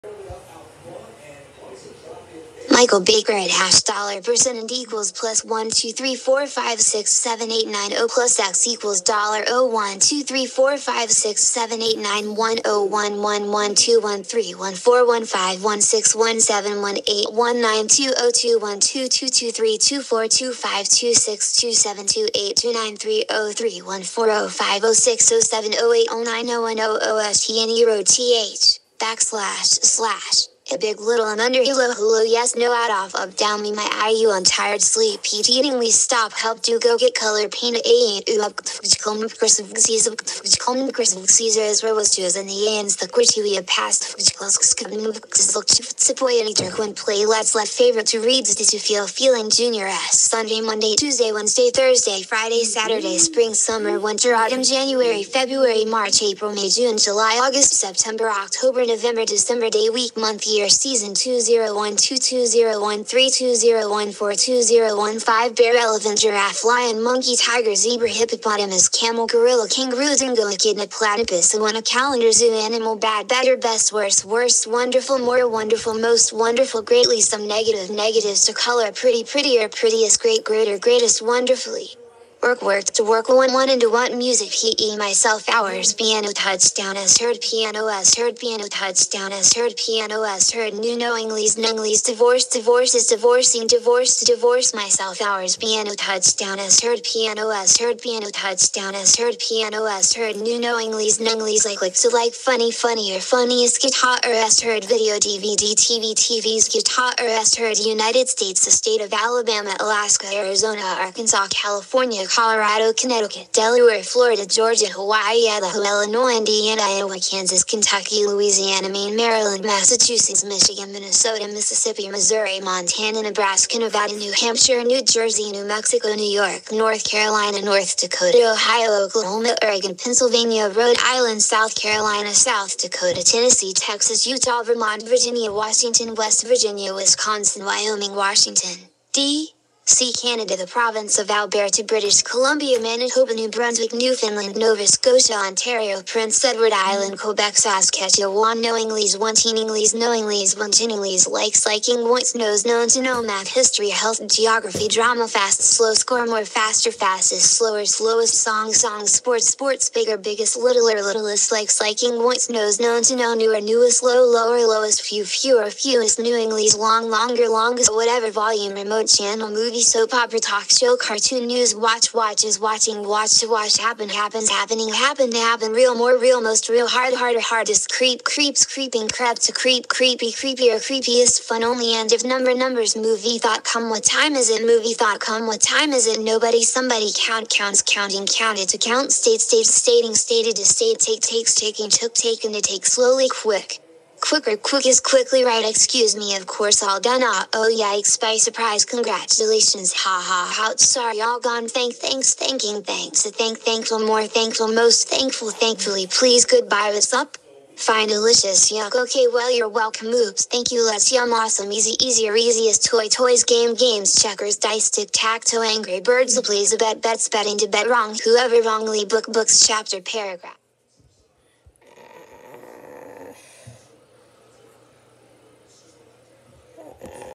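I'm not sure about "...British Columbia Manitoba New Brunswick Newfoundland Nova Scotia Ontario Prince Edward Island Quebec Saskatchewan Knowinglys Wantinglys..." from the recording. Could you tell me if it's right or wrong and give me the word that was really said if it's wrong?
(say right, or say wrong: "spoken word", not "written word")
right.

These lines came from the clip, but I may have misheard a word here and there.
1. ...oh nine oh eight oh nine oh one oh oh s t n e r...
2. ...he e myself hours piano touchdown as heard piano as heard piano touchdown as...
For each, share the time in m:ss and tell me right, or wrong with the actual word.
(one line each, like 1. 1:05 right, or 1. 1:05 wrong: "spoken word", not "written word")
1. 0:25 wrong: "seven", not "nine"
2. 1:24 right.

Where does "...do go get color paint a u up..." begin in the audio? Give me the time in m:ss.
0:36.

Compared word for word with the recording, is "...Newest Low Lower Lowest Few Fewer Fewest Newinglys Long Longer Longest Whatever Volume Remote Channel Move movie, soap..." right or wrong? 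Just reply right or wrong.
right.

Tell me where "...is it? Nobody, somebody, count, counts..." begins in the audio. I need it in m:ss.
3:05.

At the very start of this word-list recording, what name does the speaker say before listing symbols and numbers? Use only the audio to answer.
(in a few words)
Michael Baker.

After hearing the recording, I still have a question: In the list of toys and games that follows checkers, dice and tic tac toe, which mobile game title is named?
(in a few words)
Angry Birds.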